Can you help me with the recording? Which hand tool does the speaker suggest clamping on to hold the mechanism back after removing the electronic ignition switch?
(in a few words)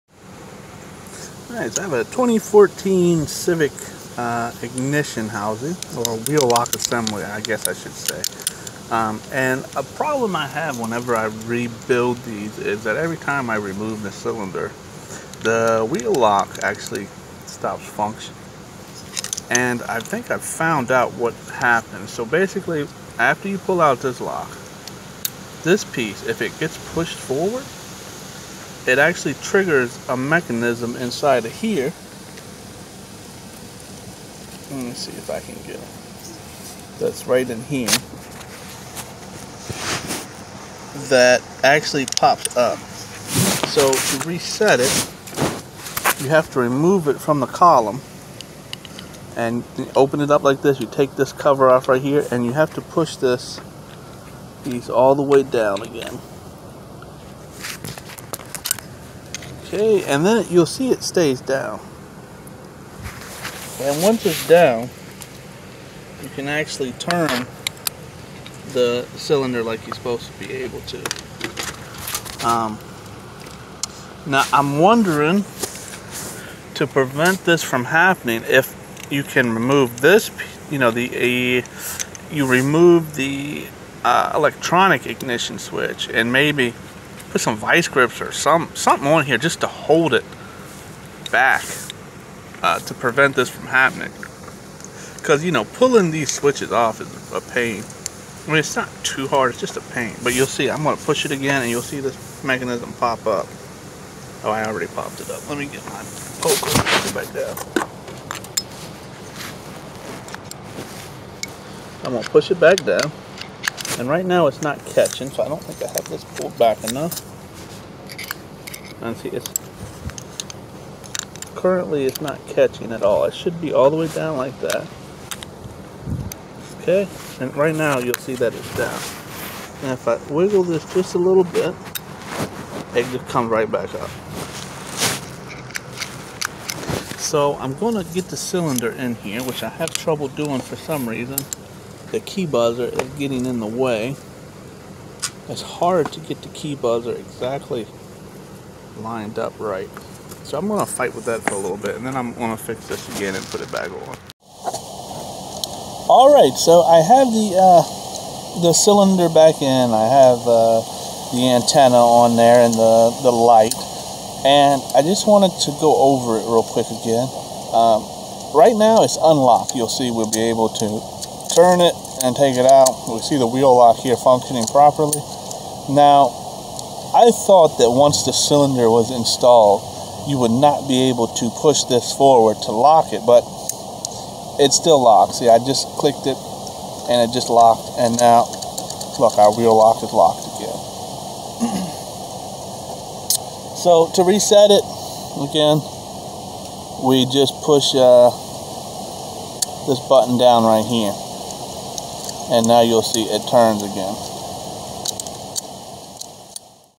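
Vice grips.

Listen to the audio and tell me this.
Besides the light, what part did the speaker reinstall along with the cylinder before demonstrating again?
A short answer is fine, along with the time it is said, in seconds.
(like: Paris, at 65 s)
Antenna, at 161 s.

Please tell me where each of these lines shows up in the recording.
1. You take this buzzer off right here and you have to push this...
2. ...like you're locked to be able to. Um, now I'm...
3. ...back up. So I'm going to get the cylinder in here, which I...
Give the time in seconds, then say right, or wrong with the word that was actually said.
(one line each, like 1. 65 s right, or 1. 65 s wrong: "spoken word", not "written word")
1. 50 s wrong: "cover", not "buzzer"
2. 69 s wrong: "supposed", not "locked"
3. 133 s right.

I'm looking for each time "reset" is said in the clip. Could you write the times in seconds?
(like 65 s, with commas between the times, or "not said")
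44 s, 194 s.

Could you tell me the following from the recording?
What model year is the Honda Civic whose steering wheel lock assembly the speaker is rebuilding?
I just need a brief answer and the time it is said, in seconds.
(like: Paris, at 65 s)
2014, at 2 s.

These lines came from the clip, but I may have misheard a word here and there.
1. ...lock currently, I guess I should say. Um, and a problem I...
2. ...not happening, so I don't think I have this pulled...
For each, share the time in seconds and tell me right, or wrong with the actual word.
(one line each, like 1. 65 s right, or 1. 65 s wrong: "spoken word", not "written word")
1. 6 s wrong: "assembly", not "currently"
2. 114 s wrong: "catching", not "happening".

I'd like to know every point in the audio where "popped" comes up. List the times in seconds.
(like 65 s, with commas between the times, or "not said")
104 s.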